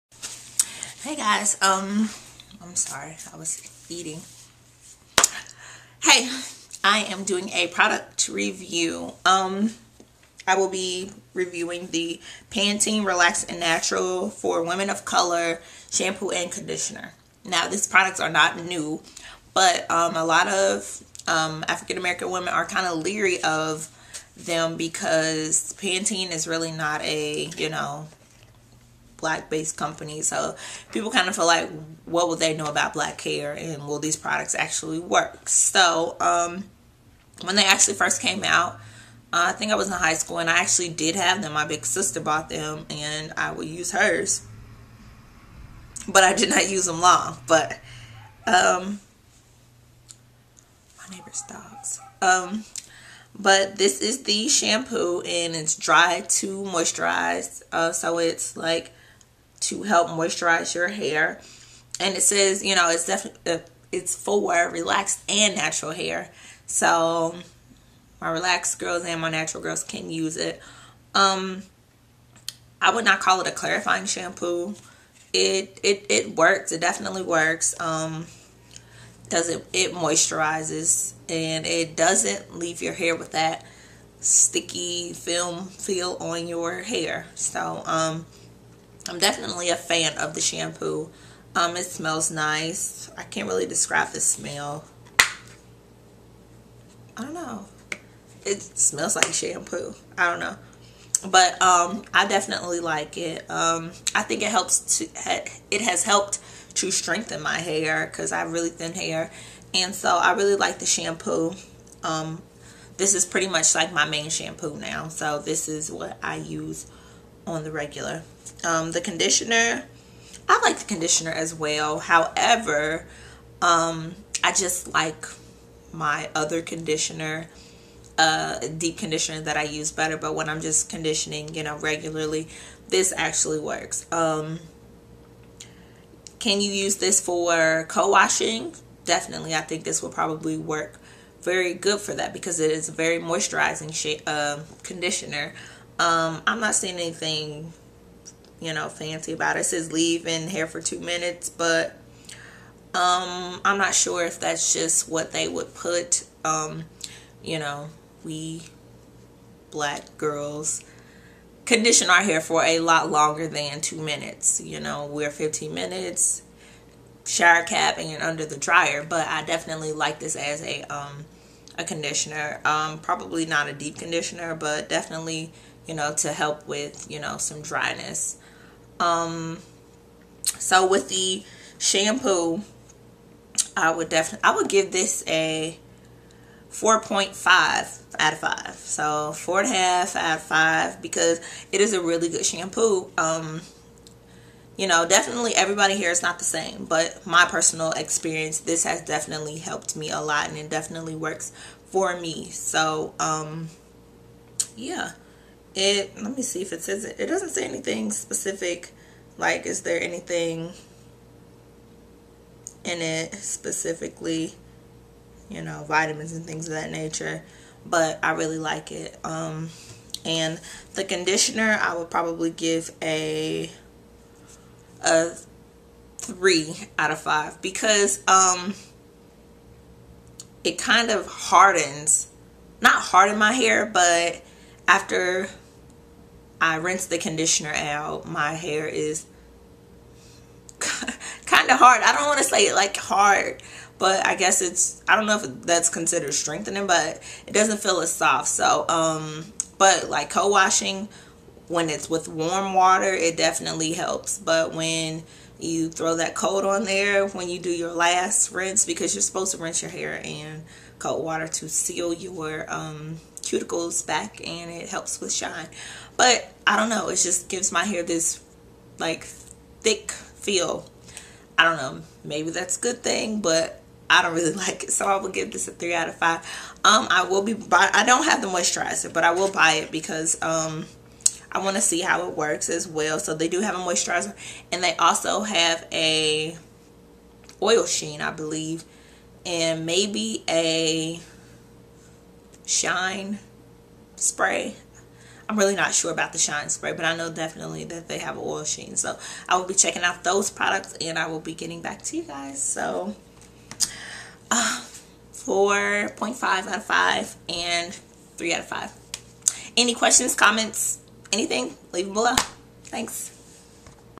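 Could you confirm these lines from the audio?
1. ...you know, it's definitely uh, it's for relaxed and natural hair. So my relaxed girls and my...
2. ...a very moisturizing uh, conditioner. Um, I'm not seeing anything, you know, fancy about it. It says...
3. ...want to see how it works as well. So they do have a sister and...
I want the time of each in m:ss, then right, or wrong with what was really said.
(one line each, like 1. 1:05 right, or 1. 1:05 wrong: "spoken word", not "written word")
1. 1:02 right
2. 2:22 right
3. 4:41 wrong: "moisturizer", not "sister".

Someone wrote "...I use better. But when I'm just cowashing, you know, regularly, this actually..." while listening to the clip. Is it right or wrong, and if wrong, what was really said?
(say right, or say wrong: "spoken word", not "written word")
wrong: "conditioning", not "cowashing".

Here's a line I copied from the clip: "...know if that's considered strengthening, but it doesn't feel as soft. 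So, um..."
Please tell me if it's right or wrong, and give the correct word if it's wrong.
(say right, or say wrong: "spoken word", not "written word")
right.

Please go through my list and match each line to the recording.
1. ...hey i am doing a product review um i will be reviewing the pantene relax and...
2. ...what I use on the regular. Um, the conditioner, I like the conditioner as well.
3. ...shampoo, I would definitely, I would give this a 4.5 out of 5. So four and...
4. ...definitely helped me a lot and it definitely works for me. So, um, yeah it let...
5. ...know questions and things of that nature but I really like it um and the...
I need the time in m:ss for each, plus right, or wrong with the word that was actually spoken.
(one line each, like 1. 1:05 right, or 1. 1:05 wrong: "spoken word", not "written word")
1. 0:06 right
2. 1:55 right
3. 3:01 right
4. 3:19 right
5. 3:35 wrong: "vitamins", not "questions".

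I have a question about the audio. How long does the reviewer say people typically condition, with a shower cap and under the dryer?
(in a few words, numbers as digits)
15 minutes.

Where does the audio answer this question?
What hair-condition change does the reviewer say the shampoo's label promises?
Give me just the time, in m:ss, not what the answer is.
0:55.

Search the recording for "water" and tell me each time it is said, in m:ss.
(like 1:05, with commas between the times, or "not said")
4:12, 4:21.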